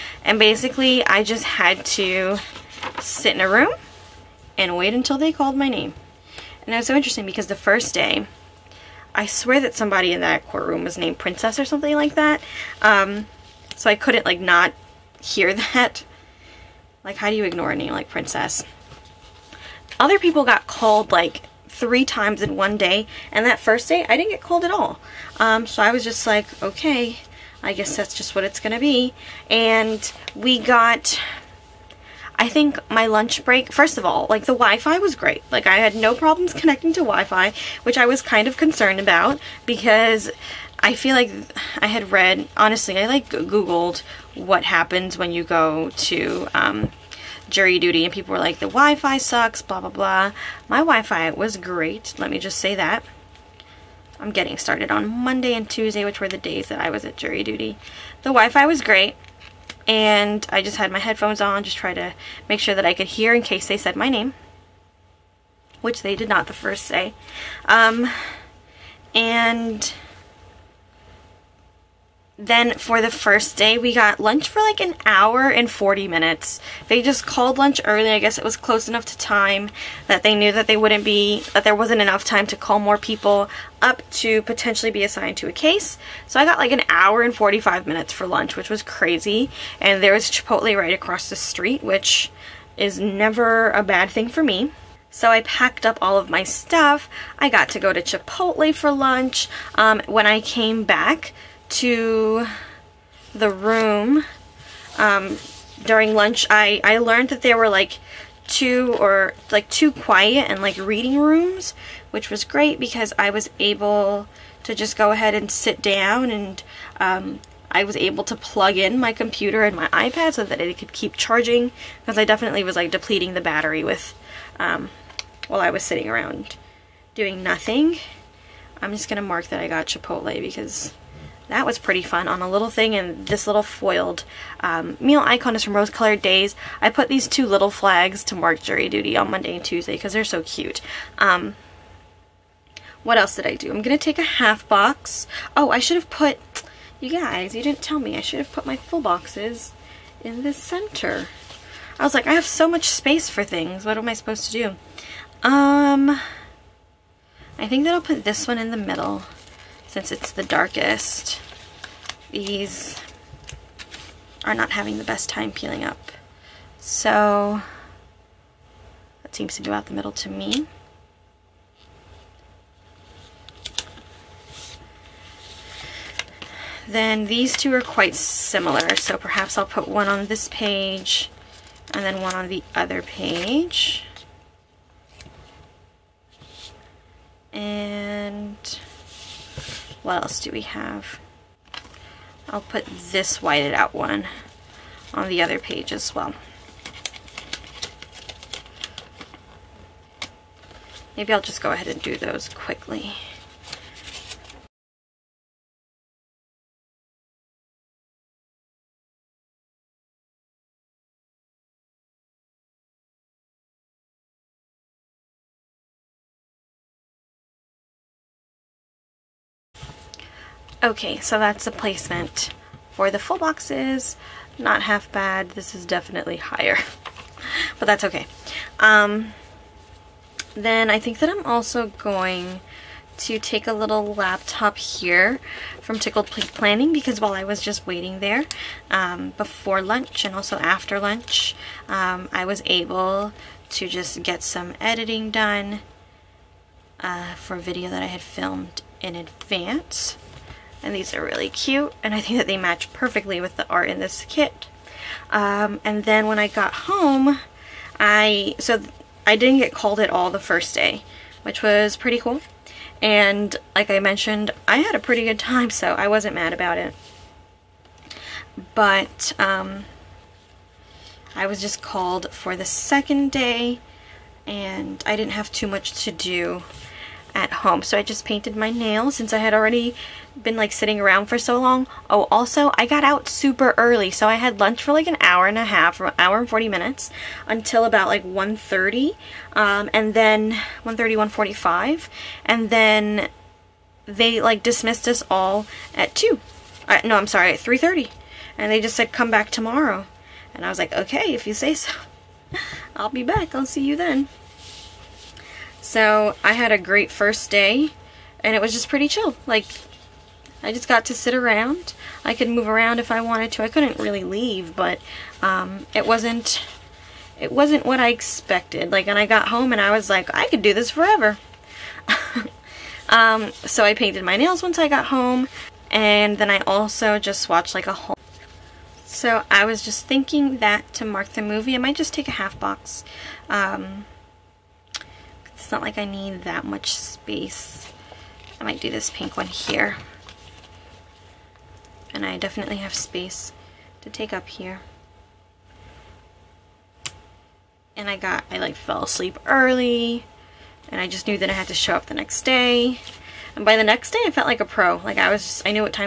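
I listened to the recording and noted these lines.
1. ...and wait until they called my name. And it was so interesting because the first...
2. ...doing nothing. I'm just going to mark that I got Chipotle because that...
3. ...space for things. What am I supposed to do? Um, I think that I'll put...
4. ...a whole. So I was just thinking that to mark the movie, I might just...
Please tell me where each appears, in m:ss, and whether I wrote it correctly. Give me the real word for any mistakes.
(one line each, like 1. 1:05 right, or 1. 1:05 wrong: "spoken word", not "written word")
1. 0:04 right
2. 2:07 right
3. 2:32 right
4. 5:27 right.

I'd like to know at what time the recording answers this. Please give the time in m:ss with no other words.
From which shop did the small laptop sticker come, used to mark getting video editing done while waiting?
3:55.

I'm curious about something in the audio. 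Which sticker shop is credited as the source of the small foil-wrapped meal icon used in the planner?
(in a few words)
Rose Colored Days.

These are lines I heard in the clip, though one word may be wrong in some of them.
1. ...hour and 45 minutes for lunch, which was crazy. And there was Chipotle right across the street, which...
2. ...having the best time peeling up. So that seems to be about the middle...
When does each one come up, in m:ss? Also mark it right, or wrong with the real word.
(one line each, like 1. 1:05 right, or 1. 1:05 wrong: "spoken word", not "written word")
1. 1:26 right
2. 2:44 right.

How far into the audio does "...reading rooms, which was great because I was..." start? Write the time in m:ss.
1:50.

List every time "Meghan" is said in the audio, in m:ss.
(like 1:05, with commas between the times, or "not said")
not said.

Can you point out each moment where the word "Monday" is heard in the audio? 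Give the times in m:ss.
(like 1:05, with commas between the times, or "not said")
0:55, 2:19.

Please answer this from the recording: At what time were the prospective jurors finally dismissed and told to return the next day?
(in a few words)
3:30.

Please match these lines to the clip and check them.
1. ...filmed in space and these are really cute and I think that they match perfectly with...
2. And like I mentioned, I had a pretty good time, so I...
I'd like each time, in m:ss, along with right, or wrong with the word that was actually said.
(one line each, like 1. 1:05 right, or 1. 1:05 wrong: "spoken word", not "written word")
1. 4:08 wrong: "advance", not "space"
2. 4:22 right.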